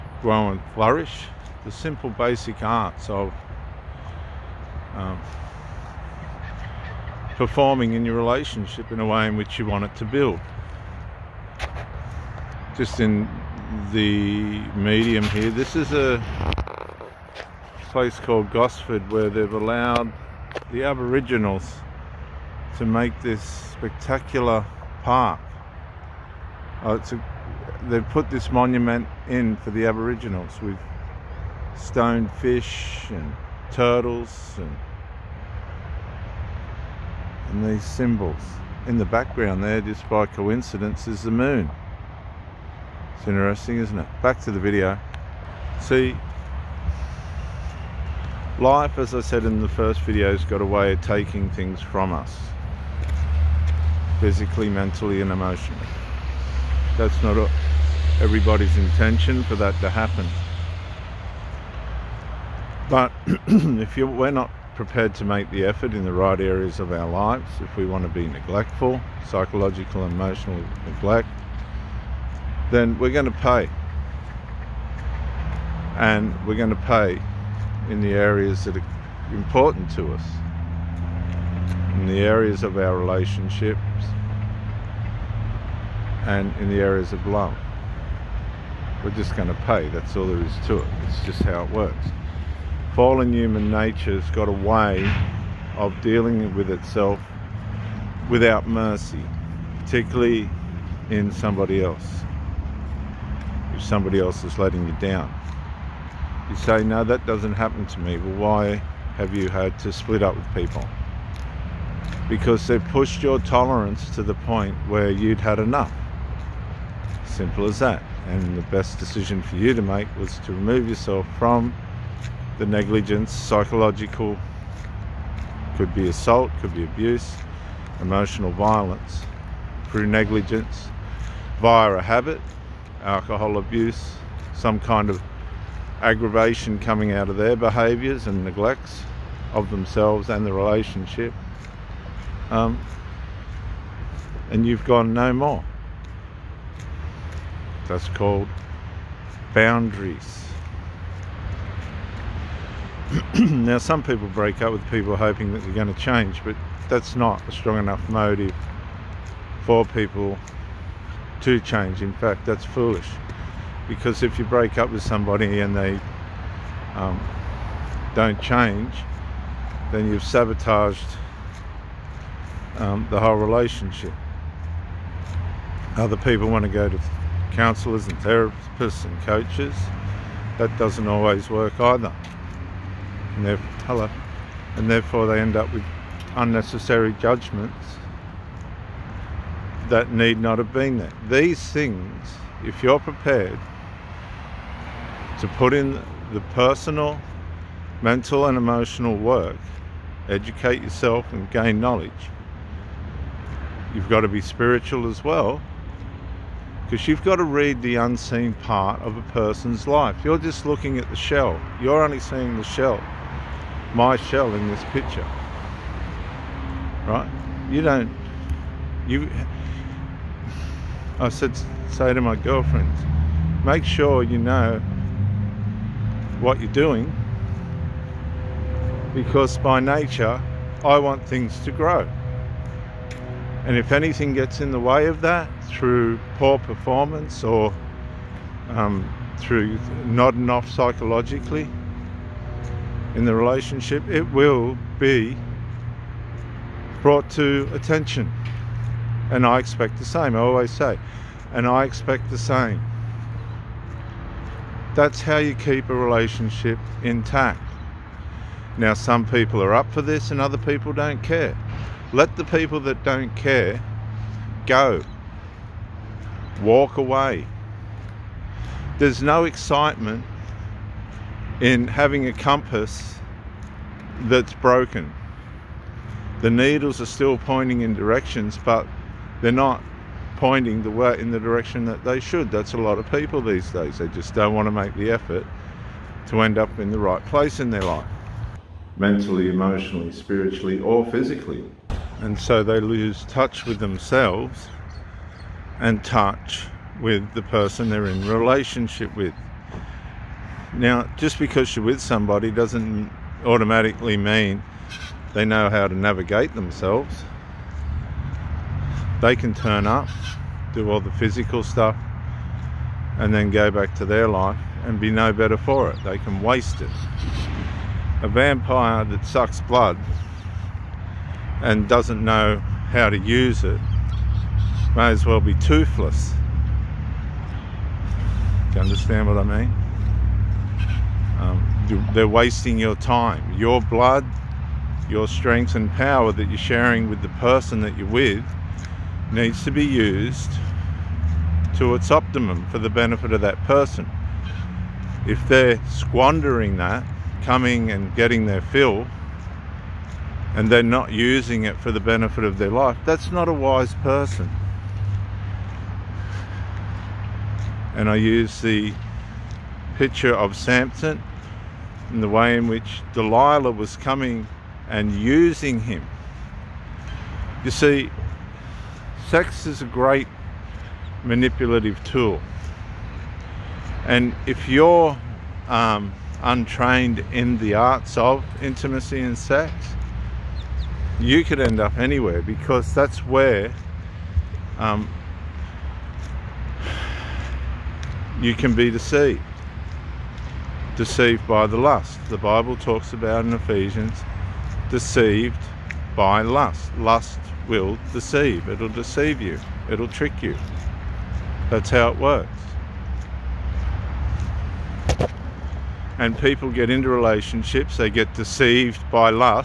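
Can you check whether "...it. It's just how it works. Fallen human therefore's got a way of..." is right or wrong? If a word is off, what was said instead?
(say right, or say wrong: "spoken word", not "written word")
wrong: "nature", not "therefore".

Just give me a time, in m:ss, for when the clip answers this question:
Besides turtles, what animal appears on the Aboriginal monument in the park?
0:31.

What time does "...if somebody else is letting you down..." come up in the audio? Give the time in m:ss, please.
1:43.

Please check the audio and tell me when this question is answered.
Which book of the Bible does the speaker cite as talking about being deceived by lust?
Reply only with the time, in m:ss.
6:33.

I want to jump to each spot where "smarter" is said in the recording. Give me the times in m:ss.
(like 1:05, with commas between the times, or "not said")
not said.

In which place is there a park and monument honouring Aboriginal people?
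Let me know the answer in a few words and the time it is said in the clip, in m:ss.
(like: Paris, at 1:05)
Gosford, at 0:18.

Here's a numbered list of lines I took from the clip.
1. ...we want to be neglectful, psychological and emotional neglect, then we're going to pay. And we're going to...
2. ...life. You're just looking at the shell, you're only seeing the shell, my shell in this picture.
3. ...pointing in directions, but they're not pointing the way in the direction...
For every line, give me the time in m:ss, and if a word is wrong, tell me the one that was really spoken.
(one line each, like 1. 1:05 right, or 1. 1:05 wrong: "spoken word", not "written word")
1. 1:07 right
2. 3:29 right
3. 4:37 right.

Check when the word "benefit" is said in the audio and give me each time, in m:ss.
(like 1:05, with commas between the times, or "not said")
5:42, 5:51.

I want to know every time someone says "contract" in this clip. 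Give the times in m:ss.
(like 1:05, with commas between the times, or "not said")
not said.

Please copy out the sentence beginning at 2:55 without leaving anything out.
Other people want to go to counsellors and therapists and coaches.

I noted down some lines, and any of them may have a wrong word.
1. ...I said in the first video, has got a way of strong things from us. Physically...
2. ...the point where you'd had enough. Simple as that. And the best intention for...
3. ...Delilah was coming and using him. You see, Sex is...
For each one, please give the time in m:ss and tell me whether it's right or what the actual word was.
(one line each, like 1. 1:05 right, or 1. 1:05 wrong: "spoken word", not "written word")
1. 0:49 wrong: "taking", not "strong"
2. 1:54 wrong: "decision", not "intention"
3. 6:03 right.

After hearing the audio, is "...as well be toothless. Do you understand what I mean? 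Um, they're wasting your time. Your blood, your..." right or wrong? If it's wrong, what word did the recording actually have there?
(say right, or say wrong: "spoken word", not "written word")
right.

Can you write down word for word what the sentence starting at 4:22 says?
Let the people that don't care go.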